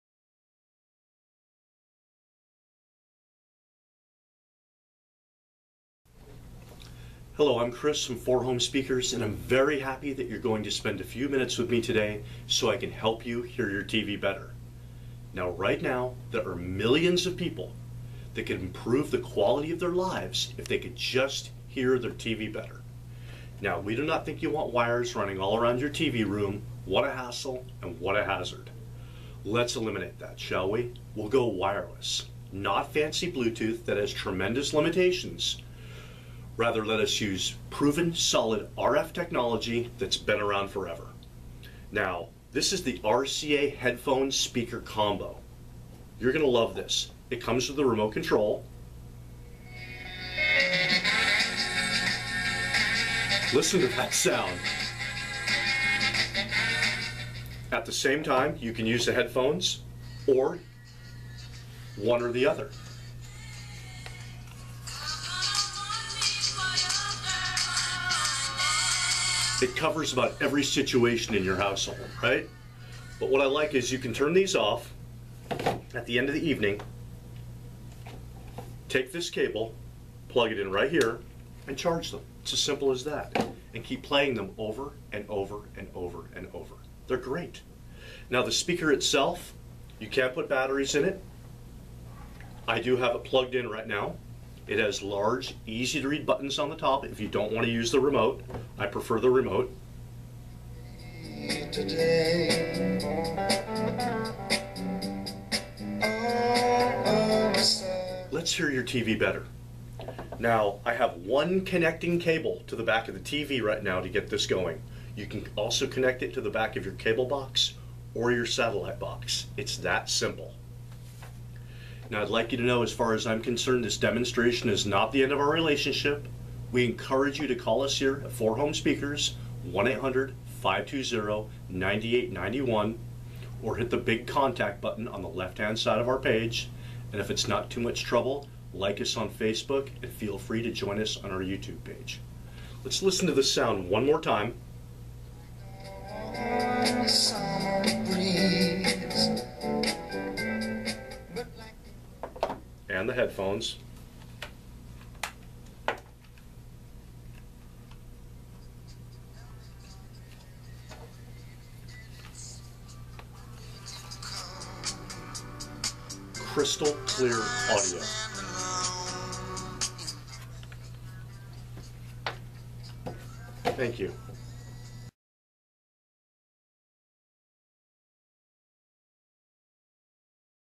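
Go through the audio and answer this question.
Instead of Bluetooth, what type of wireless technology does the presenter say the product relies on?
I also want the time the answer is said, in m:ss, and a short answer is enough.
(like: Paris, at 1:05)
RF technology, at 0:38.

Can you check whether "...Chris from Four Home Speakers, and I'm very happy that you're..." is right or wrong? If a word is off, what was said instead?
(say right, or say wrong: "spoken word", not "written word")
right.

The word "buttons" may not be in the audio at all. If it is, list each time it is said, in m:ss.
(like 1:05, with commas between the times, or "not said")
1:36, 2:14.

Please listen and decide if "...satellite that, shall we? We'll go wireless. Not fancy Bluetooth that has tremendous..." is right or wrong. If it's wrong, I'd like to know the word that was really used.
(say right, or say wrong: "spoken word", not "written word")
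wrong: "eliminate", not "satellite".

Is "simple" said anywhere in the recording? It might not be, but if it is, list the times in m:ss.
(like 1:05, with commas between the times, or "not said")
1:22, 2:00.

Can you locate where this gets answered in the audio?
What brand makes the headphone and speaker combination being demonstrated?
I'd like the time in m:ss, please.
0:42.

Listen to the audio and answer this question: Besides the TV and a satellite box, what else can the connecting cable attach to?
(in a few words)
cable box.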